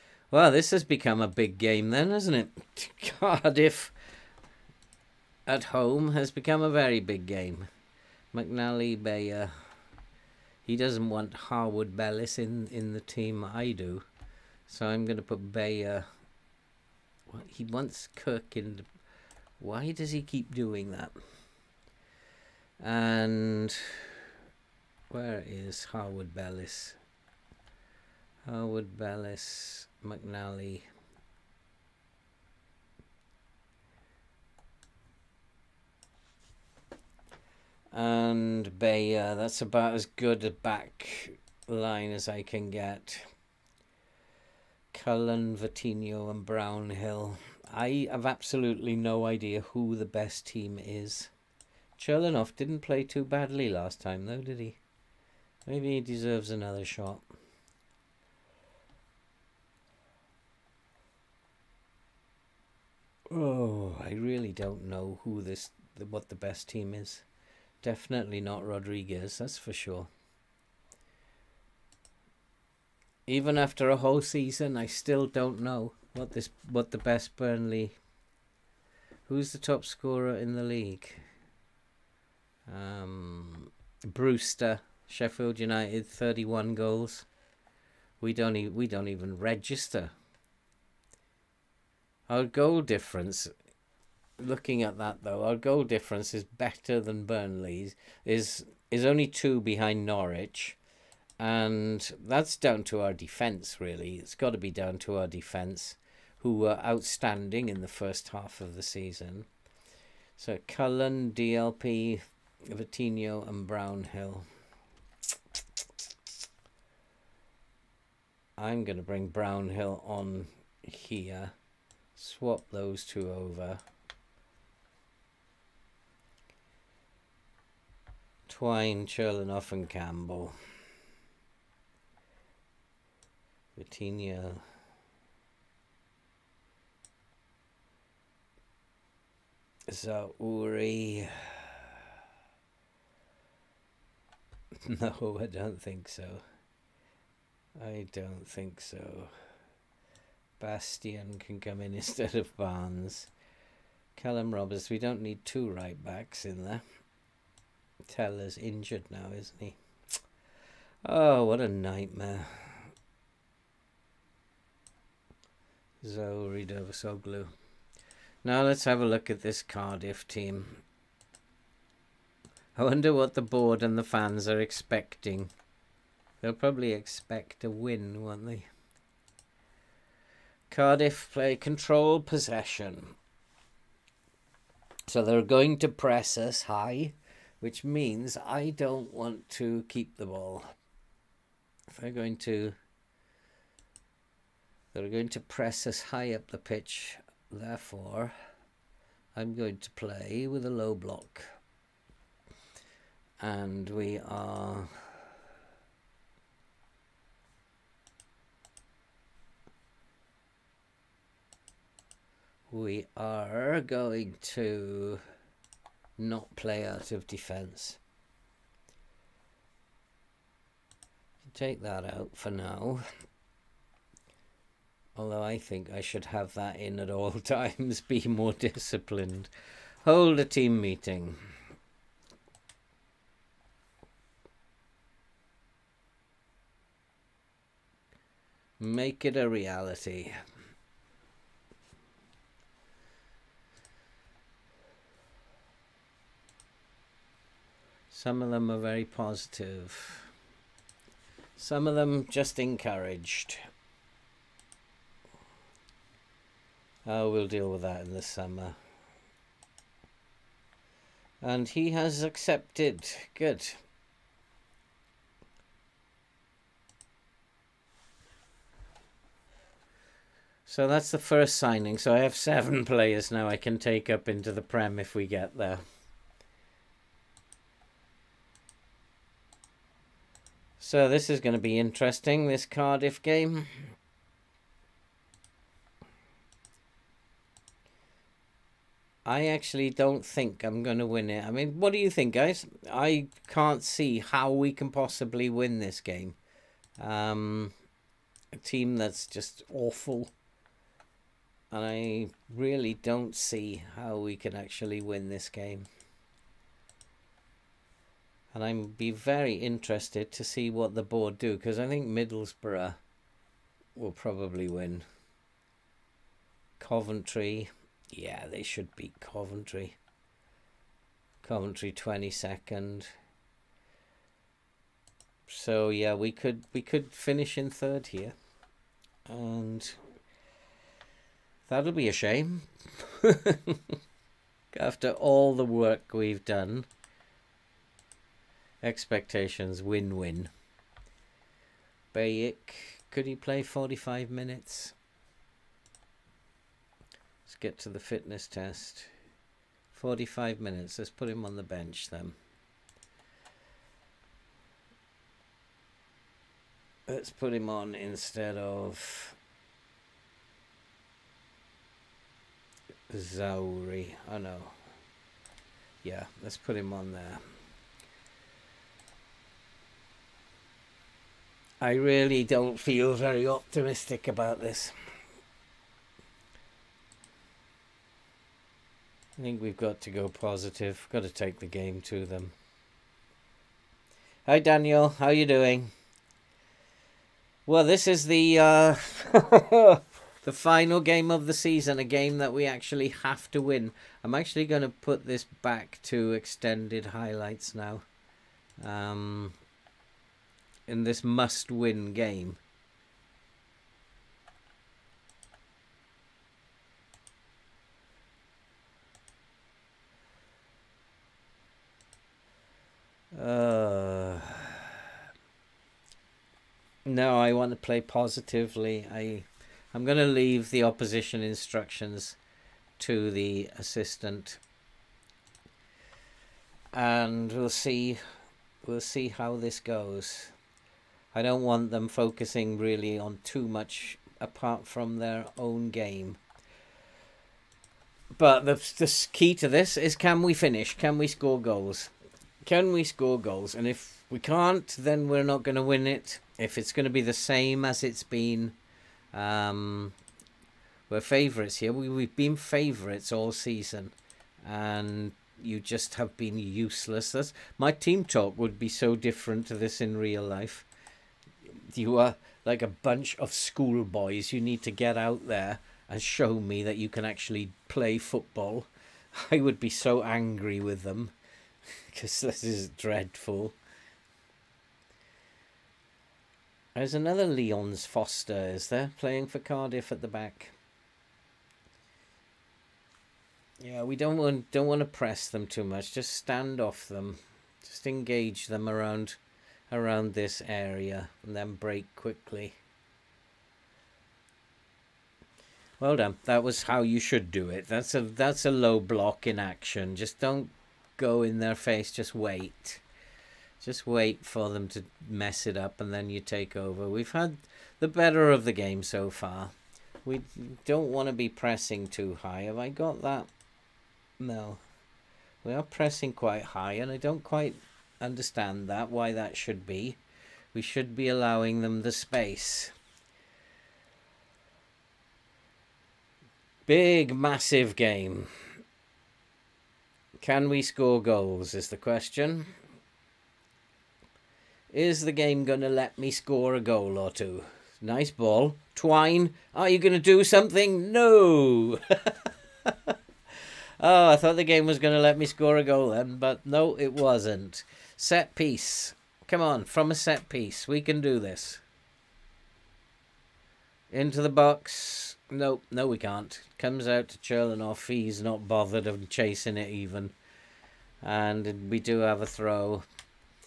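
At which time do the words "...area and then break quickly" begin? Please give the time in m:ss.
8:10.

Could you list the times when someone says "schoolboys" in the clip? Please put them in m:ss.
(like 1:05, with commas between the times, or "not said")
7:43.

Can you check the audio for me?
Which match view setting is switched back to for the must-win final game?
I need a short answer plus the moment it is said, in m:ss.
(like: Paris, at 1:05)
extended highlights, at 6:36.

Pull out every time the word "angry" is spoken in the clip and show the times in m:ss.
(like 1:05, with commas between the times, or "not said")
7:50.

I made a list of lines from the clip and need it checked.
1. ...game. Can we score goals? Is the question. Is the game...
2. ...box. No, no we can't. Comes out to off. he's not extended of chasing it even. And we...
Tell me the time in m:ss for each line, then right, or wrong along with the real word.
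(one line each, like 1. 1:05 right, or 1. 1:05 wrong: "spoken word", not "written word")
1. 8:47 right
2. 9:14 wrong: "bothered", not "extended".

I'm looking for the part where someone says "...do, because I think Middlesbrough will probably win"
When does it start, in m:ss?
5:11.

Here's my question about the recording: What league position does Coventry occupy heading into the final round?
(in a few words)
22nd.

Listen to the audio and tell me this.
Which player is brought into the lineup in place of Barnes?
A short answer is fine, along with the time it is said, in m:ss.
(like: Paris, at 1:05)
Bastien, at 2:30.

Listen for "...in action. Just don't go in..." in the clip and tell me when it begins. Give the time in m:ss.
8:19.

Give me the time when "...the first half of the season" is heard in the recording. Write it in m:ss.
1:47.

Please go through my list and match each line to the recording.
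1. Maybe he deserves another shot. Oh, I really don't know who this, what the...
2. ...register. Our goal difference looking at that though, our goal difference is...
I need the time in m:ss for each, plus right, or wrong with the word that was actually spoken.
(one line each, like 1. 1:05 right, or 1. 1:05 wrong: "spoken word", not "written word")
1. 0:55 right
2. 1:29 right.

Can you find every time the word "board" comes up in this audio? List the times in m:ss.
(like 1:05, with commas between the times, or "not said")
2:53, 5:11.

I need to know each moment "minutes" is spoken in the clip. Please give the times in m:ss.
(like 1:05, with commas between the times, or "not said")
5:44, 5:50.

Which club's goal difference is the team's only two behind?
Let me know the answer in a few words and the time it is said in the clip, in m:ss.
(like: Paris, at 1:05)
Norwich, at 1:40.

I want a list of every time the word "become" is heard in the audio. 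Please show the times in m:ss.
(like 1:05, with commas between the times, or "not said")
0:00, 0:06.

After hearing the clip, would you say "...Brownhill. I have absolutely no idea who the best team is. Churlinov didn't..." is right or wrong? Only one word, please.
right.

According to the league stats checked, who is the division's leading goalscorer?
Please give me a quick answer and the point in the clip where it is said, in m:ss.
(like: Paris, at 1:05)
Brewster, at 1:24.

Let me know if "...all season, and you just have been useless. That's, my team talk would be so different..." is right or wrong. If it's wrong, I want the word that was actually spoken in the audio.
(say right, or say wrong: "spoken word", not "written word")
right.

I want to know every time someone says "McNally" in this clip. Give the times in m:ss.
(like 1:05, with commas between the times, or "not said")
0:08, 0:30.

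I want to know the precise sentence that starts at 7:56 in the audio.
There's another Leon's Foster, is there, playing for Cardiff at the back.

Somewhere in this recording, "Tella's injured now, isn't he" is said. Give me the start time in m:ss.
2:38.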